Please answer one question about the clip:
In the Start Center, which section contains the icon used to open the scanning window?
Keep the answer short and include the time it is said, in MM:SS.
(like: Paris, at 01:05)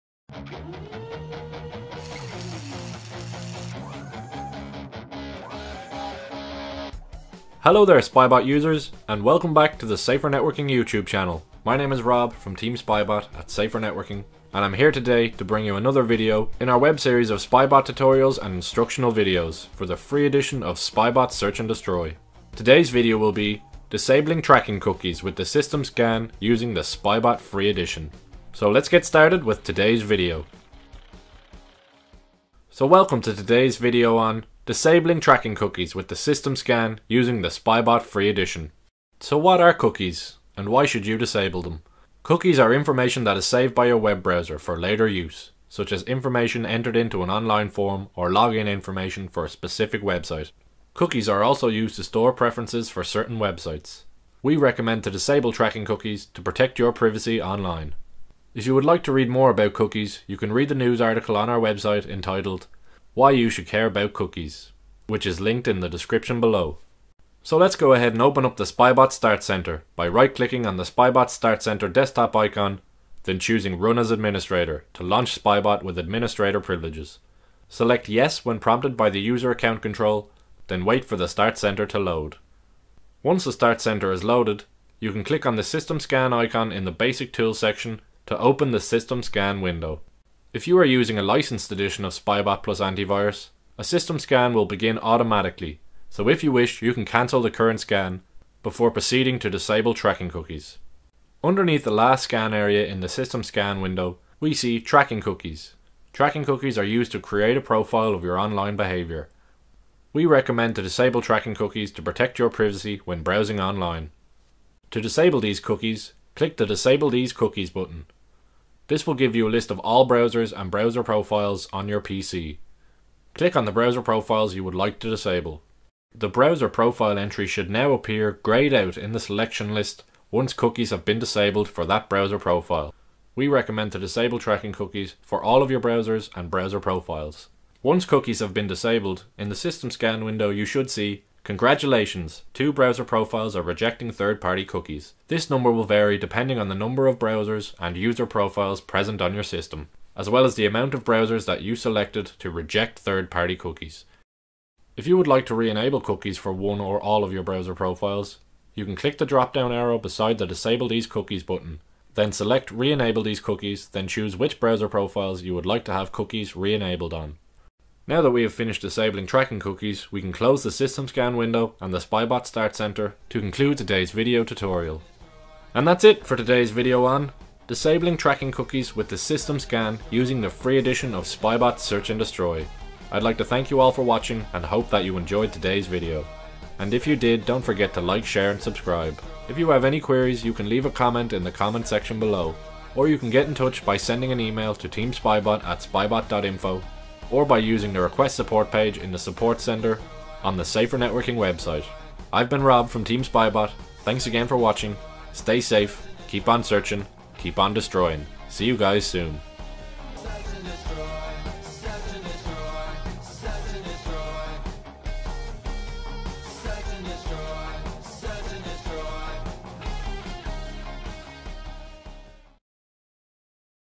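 Basic Tools, at 01:26.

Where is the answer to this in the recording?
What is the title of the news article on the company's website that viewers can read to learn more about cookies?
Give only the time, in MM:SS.
01:03.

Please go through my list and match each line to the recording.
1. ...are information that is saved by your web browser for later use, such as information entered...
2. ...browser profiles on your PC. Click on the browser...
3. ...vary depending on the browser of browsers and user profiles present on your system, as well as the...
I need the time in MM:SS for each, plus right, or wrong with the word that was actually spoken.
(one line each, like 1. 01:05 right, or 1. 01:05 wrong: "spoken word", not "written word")
1. 00:42 right
2. 02:00 right
3. 02:25 wrong: "number", not "browser".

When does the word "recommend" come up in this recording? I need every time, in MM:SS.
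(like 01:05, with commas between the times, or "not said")
00:54, 01:50, 02:13.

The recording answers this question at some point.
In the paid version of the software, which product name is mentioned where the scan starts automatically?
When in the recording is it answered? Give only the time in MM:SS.
01:32.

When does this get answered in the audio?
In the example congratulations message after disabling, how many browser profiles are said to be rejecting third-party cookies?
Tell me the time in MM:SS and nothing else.
02:22.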